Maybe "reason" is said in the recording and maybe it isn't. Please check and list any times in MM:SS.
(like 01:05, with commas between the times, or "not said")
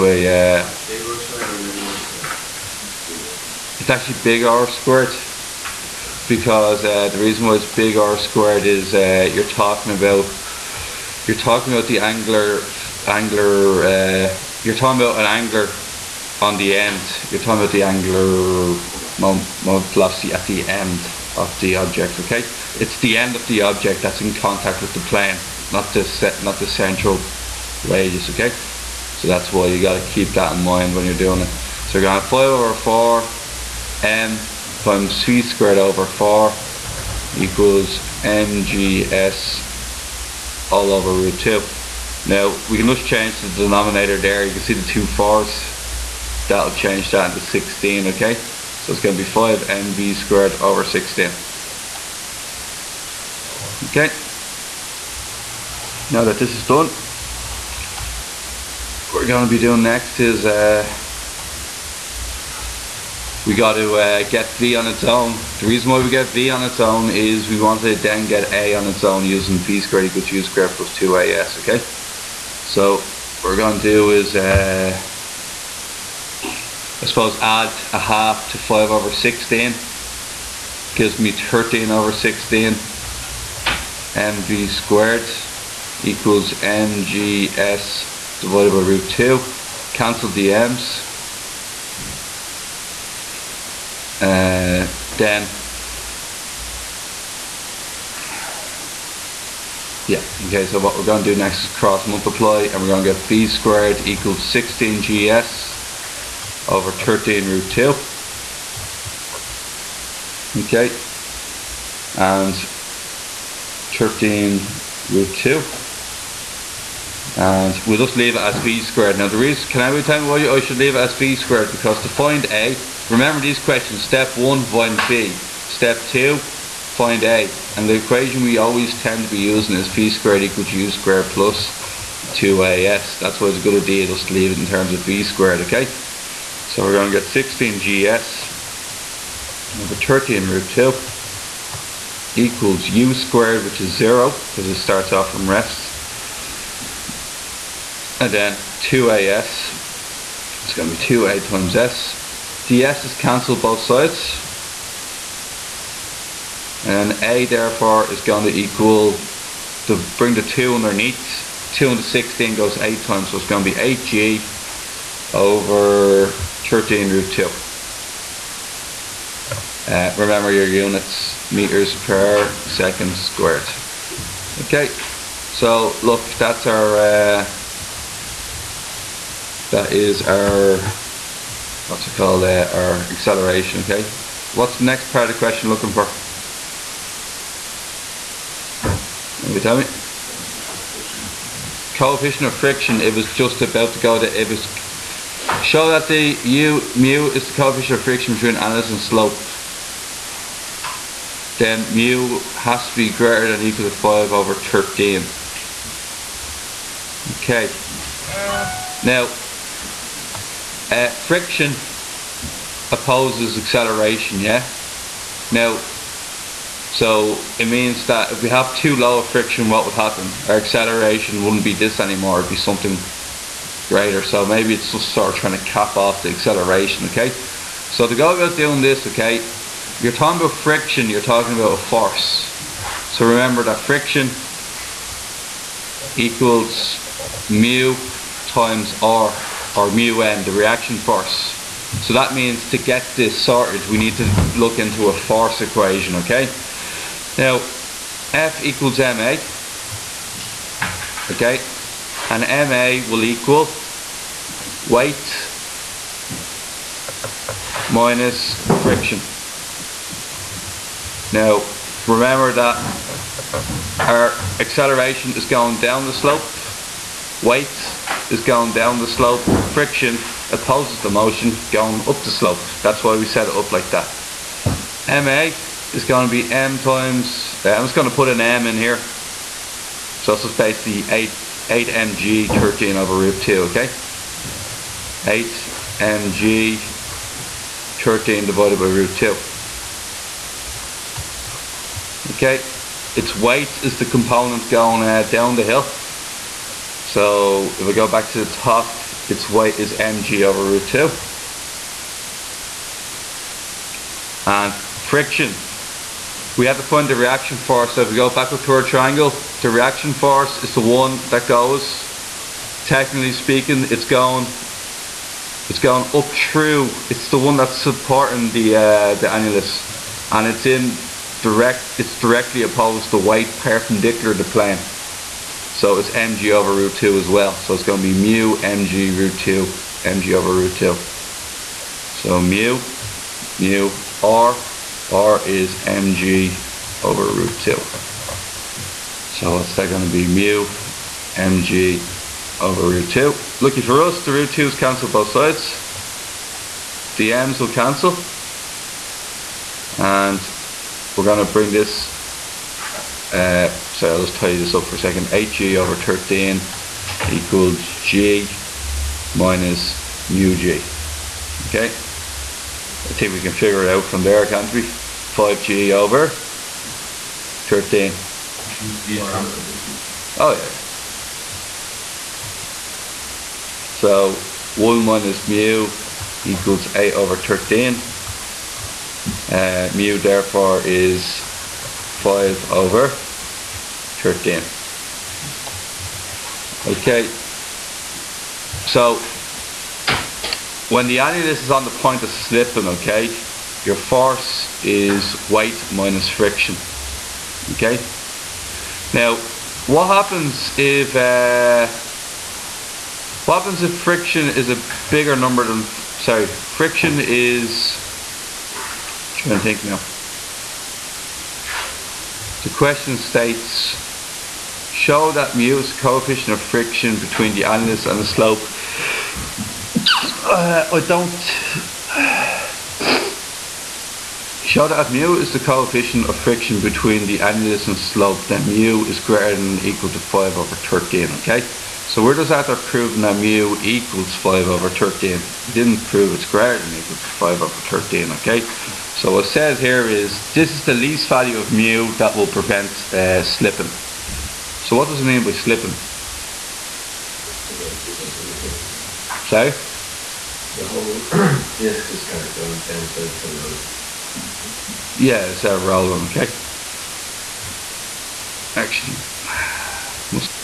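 00:07, 01:05, 01:59.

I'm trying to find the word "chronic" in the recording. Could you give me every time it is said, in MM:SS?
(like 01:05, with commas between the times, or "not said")
not said.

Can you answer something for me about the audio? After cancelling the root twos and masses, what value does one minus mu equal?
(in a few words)
8/13.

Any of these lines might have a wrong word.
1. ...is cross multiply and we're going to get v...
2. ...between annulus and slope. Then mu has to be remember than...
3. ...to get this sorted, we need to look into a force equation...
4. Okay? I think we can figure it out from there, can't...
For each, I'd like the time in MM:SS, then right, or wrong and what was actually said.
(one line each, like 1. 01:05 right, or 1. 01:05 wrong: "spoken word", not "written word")
1. 01:41 right
2. 03:18 wrong: "greater", not "remember"
3. 04:02 right
4. 06:01 right.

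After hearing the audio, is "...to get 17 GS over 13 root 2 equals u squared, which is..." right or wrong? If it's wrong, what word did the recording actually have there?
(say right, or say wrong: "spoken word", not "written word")
wrong: "16", not "17".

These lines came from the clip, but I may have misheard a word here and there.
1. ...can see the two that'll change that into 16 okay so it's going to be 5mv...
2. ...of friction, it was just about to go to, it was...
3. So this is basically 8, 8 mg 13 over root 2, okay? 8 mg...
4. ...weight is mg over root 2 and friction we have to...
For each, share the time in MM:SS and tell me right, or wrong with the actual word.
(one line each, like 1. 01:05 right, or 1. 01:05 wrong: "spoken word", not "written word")
1. 00:44 right
2. 03:12 right
3. 04:40 right
4. 04:59 right.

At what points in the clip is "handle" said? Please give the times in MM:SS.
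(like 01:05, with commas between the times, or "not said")
not said.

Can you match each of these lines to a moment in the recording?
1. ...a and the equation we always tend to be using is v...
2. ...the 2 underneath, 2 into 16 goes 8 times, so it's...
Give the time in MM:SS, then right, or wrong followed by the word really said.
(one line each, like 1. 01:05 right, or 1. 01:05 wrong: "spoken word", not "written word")
1. 02:07 right
2. 02:40 right.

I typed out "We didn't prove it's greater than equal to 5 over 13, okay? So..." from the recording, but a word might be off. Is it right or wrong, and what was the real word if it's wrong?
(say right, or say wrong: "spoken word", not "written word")
right.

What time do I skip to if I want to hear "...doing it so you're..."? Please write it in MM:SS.
00:31.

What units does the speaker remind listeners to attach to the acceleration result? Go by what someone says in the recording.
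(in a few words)
meters per second squared.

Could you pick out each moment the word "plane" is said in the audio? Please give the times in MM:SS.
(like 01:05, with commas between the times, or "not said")
00:25, 05:24.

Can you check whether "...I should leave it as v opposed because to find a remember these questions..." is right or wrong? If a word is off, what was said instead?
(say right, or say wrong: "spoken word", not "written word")
wrong: "squared", not "opposed".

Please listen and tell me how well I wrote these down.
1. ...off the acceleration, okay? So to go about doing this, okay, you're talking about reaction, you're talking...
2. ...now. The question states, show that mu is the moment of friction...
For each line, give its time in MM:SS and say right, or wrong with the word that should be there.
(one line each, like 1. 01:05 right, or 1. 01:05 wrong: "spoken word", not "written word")
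1. 03:45 wrong: "friction", not "reaction"
2. 06:49 wrong: "coefficient", not "moment".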